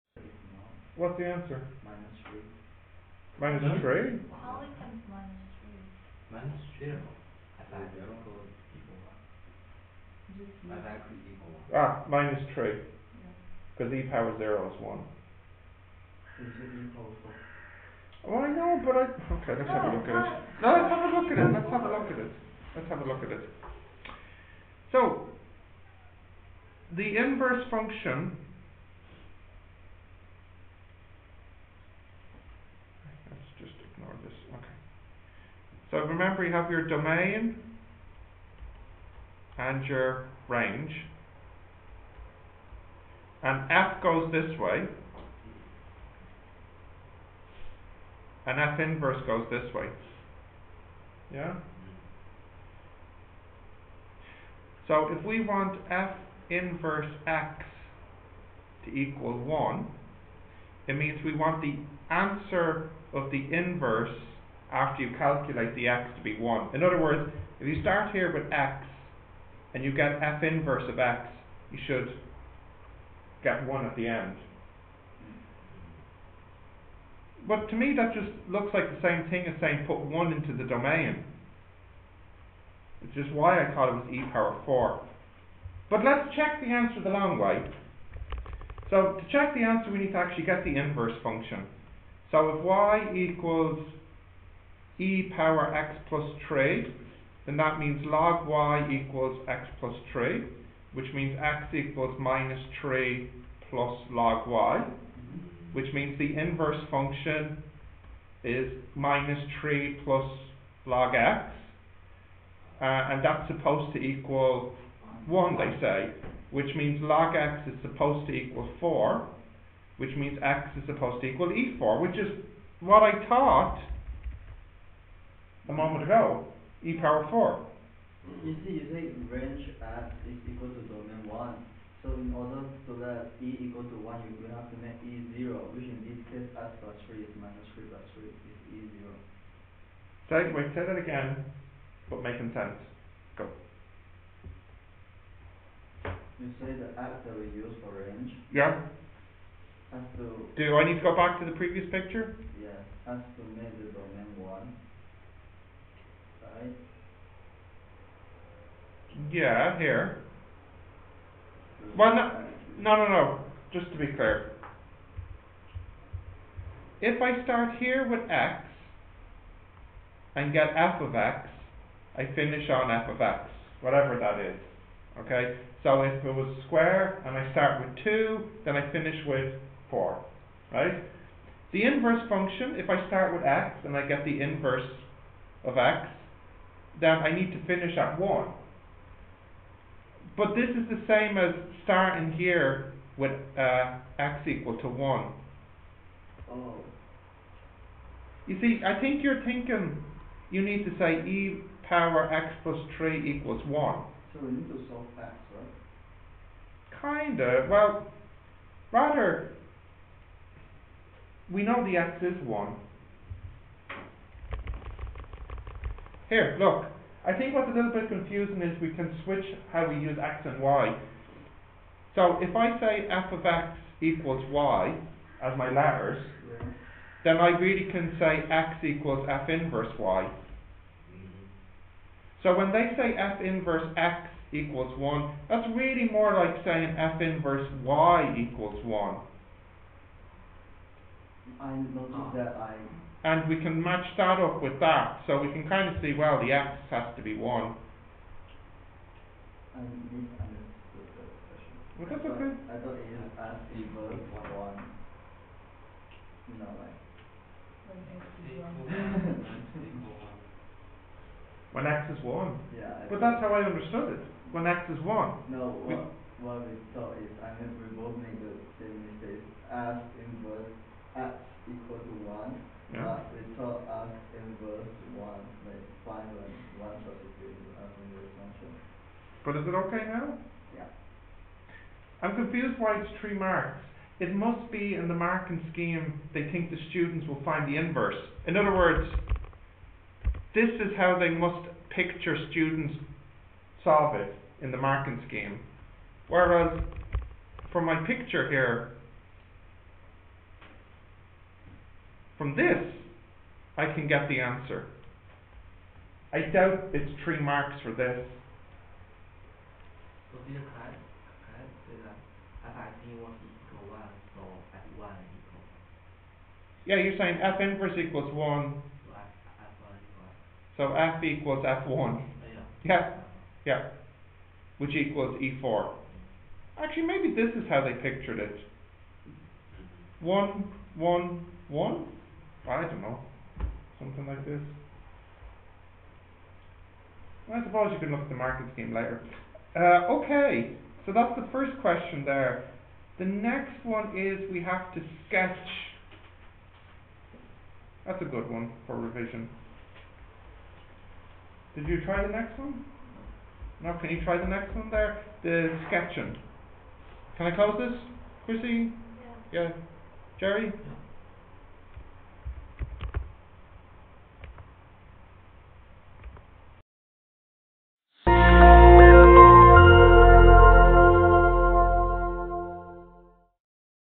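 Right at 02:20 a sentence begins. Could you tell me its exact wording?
Say, wait, say that again, but making sense.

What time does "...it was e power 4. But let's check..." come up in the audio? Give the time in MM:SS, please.
01:23.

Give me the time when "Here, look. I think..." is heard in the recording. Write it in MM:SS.
03:36.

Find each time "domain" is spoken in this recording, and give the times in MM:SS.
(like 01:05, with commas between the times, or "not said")
00:36, 01:20, 02:10, 02:33.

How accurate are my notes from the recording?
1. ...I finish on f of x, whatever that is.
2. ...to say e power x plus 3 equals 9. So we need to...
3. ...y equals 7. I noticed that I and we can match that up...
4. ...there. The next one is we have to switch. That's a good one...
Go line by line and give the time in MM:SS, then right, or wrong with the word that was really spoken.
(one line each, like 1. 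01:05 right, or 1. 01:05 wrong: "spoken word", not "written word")
1. 02:52 right
2. 03:20 wrong: "1", not "9"
3. 03:57 wrong: "1", not "7"
4. 05:42 wrong: "sketch", not "switch".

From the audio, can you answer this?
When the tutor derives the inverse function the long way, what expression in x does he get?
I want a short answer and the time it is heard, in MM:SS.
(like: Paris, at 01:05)
3 plus log x, at 01:49.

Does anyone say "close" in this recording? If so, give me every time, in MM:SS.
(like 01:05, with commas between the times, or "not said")
05:57.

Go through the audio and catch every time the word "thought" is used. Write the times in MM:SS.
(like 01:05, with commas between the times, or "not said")
01:23, 02:03, 04:12, 04:26.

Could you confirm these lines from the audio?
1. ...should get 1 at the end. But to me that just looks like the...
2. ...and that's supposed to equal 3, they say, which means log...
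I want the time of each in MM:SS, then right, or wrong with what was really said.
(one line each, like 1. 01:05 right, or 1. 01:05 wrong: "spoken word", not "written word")
1. 01:11 right
2. 01:52 wrong: "1", not "3".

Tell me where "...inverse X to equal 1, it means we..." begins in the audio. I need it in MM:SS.
00:56.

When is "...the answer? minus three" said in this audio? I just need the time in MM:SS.
00:01.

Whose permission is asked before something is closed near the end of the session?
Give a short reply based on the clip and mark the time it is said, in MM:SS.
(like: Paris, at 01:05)
Chrissy, at 05:58.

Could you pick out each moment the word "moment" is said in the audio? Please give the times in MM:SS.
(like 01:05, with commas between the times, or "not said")
02:05.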